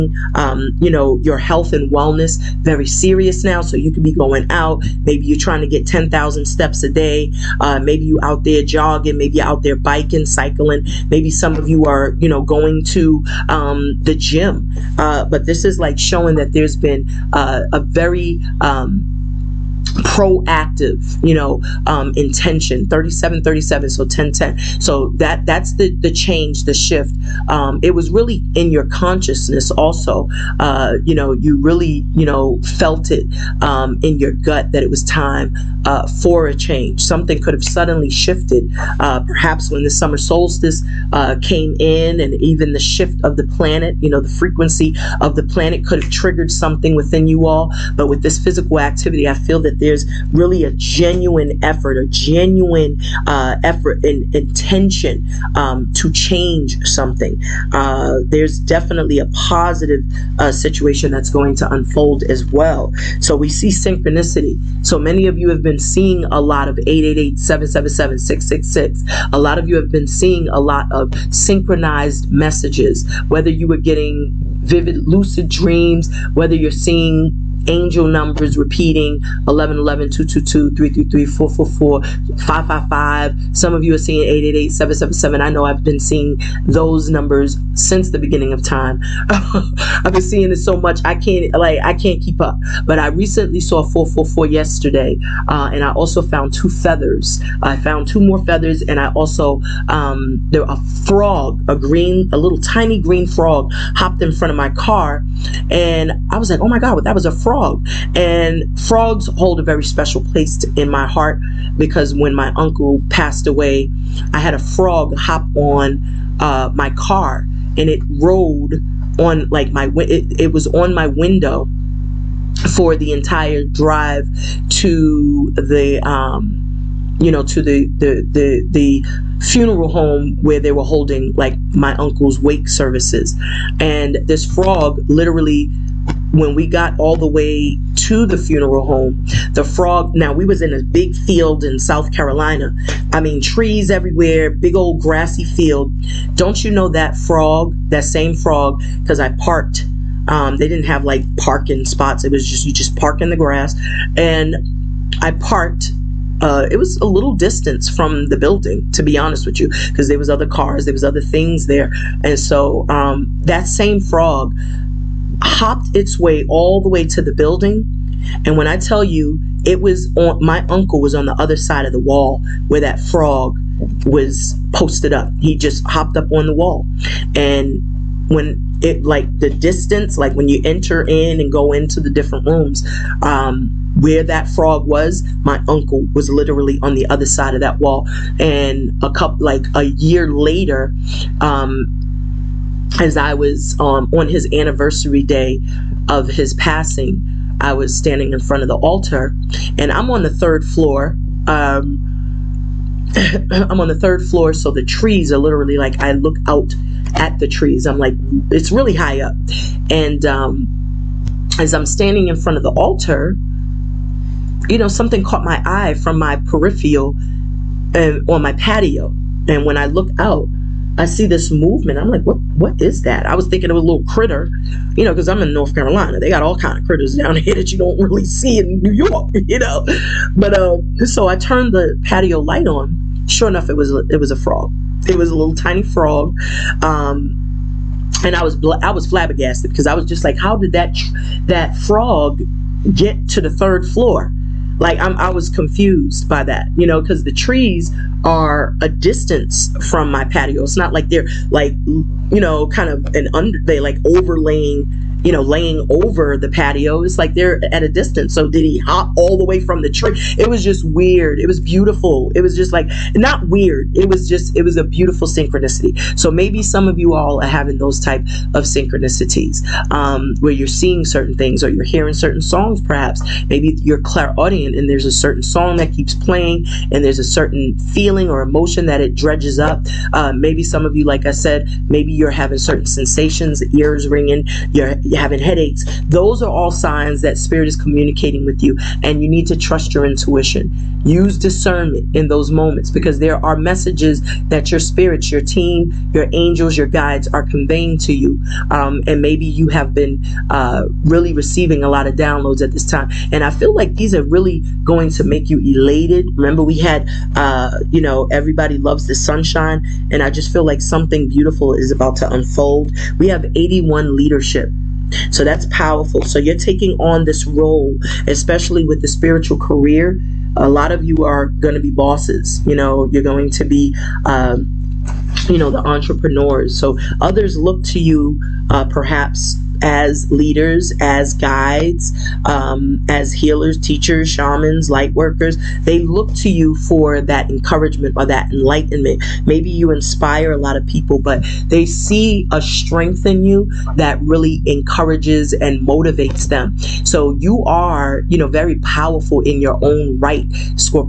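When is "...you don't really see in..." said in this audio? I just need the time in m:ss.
3:47.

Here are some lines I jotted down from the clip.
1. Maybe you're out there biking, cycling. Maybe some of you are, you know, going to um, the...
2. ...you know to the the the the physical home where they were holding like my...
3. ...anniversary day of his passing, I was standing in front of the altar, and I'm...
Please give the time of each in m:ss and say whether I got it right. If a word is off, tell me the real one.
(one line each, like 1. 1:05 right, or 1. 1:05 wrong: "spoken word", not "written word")
1. 0:09 right
2. 2:07 wrong: "funeral", not "physical"
3. 3:14 right.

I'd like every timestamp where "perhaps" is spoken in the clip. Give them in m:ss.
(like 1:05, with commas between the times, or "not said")
0:39, 4:32, 5:28.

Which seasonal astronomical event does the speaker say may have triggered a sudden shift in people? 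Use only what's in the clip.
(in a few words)
summer solstice.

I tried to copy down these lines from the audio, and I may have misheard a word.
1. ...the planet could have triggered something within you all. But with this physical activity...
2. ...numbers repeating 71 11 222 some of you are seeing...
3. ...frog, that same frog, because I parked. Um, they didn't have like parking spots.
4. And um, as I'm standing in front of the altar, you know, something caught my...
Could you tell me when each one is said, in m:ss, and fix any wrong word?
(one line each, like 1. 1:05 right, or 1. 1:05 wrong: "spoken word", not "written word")
1. 0:45 right
2. 1:18 wrong: "11", not "71"
3. 2:27 right
4. 3:29 right.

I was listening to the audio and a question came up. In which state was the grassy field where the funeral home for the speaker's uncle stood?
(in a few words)
South Carolina.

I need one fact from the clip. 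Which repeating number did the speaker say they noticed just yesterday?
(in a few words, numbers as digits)
444.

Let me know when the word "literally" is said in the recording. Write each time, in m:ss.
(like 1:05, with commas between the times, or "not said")
2:15, 3:06, 3:25.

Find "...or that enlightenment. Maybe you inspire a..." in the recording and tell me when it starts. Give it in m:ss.
5:38.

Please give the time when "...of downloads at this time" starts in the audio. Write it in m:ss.
5:02.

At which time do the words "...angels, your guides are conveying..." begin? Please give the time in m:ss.
4:56.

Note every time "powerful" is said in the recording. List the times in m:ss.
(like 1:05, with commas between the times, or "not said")
5:15, 5:48.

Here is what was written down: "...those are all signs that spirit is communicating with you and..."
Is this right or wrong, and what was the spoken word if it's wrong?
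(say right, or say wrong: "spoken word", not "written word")
right.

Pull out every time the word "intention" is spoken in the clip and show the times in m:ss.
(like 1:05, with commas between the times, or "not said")
0:22, 0:54.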